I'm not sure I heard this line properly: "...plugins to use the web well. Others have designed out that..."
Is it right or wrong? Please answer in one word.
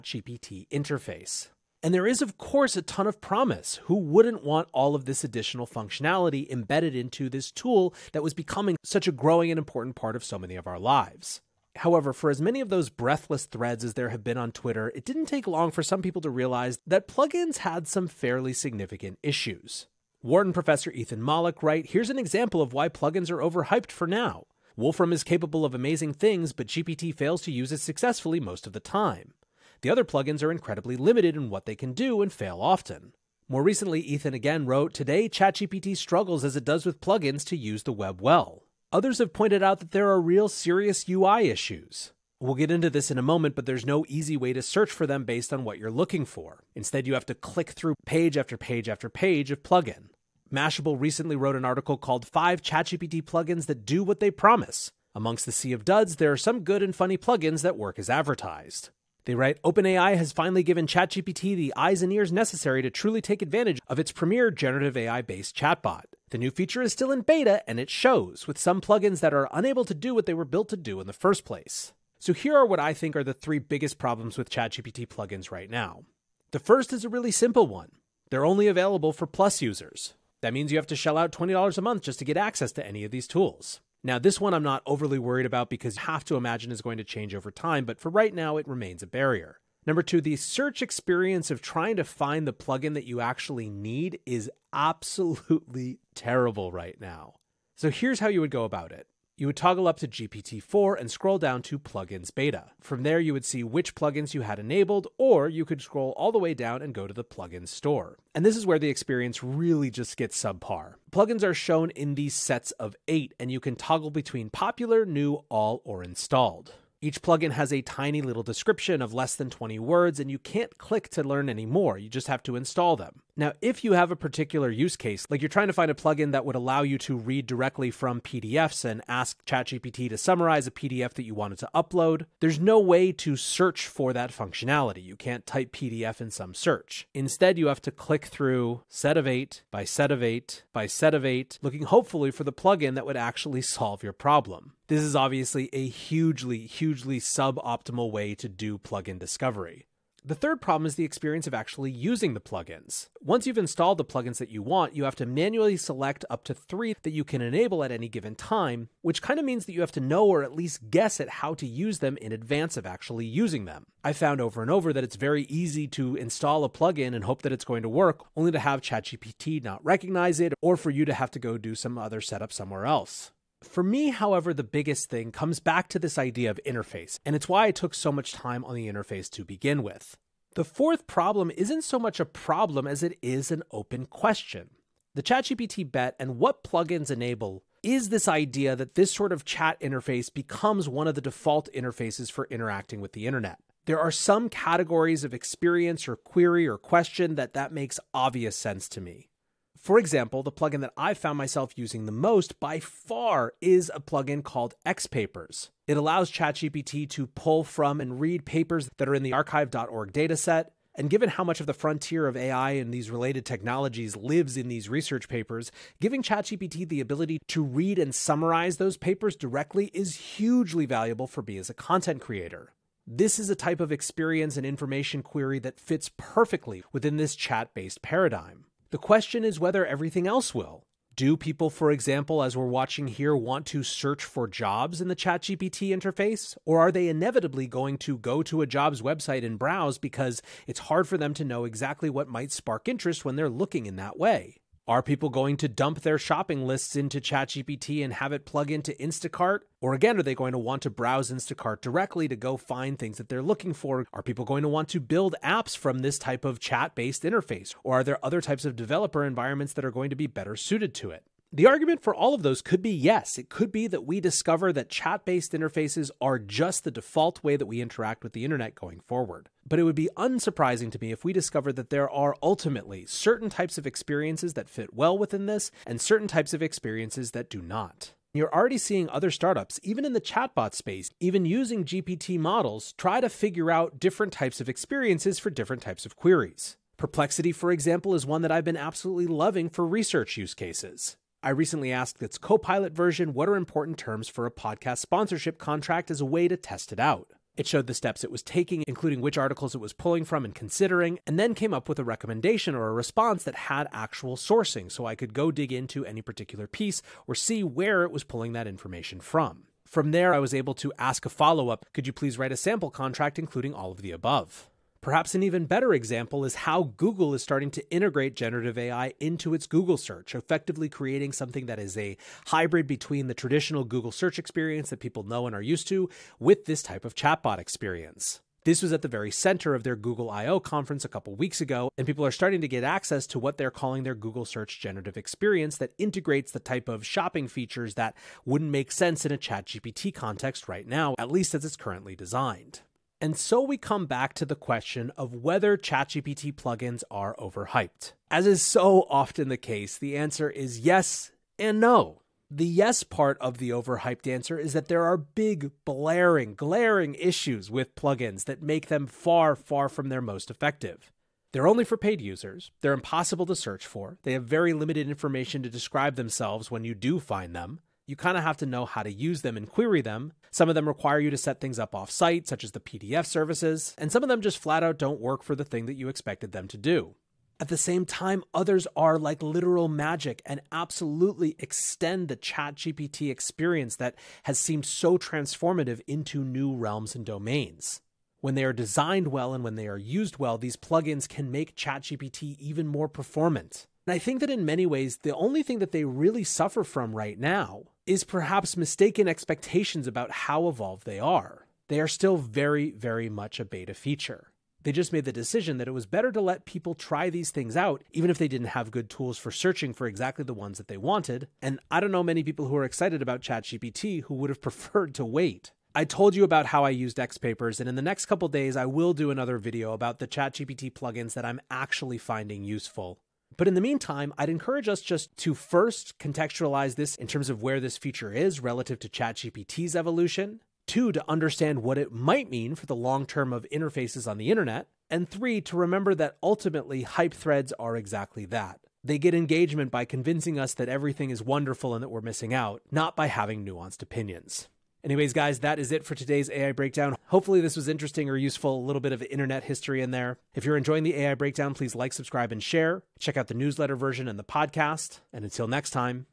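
wrong.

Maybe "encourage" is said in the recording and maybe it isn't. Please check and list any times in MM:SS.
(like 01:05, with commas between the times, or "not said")
07:04.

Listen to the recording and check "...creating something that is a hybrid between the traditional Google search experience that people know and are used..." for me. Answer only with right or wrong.
right.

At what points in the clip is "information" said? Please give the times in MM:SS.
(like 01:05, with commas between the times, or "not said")
03:44, 05:08, 06:05.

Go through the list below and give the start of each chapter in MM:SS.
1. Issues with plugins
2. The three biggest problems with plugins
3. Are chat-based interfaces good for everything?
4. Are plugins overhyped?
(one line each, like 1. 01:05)
1. 00:19
2. 01:12
3. 02:52
4. 05:43.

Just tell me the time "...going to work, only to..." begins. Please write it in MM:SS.
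02:47.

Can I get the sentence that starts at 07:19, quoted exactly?
They get engagement by convincing us that everything is wonderful and that we're missing out, not by having nuanced opinions.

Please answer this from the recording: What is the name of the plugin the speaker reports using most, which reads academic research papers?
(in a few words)
XPapers.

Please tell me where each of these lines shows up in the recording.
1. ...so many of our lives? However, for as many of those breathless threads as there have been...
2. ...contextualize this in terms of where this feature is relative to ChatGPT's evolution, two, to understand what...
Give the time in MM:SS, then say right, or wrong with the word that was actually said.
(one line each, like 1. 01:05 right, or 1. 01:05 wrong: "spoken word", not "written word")
1. 00:10 right
2. 07:06 right.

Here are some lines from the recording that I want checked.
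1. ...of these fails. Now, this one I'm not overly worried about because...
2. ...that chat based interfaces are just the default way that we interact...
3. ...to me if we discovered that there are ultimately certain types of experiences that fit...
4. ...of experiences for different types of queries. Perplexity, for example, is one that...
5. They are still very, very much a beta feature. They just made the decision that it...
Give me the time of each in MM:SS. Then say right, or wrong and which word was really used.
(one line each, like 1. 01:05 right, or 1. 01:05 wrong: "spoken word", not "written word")
1. 01:23 wrong: "tools", not "fails"
2. 04:24 right
3. 04:30 right
4. 04:44 right
5. 06:41 right.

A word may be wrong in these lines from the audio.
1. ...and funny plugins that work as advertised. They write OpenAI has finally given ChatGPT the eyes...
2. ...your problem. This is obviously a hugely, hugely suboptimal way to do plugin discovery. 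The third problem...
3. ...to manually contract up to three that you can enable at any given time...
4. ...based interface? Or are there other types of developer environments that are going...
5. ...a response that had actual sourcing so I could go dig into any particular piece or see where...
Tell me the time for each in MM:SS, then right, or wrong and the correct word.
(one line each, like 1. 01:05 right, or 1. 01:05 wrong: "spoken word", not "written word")
1. 00:56 right
2. 02:24 right
3. 02:35 wrong: "select", not "contract"
4. 04:16 right
5. 05:02 right.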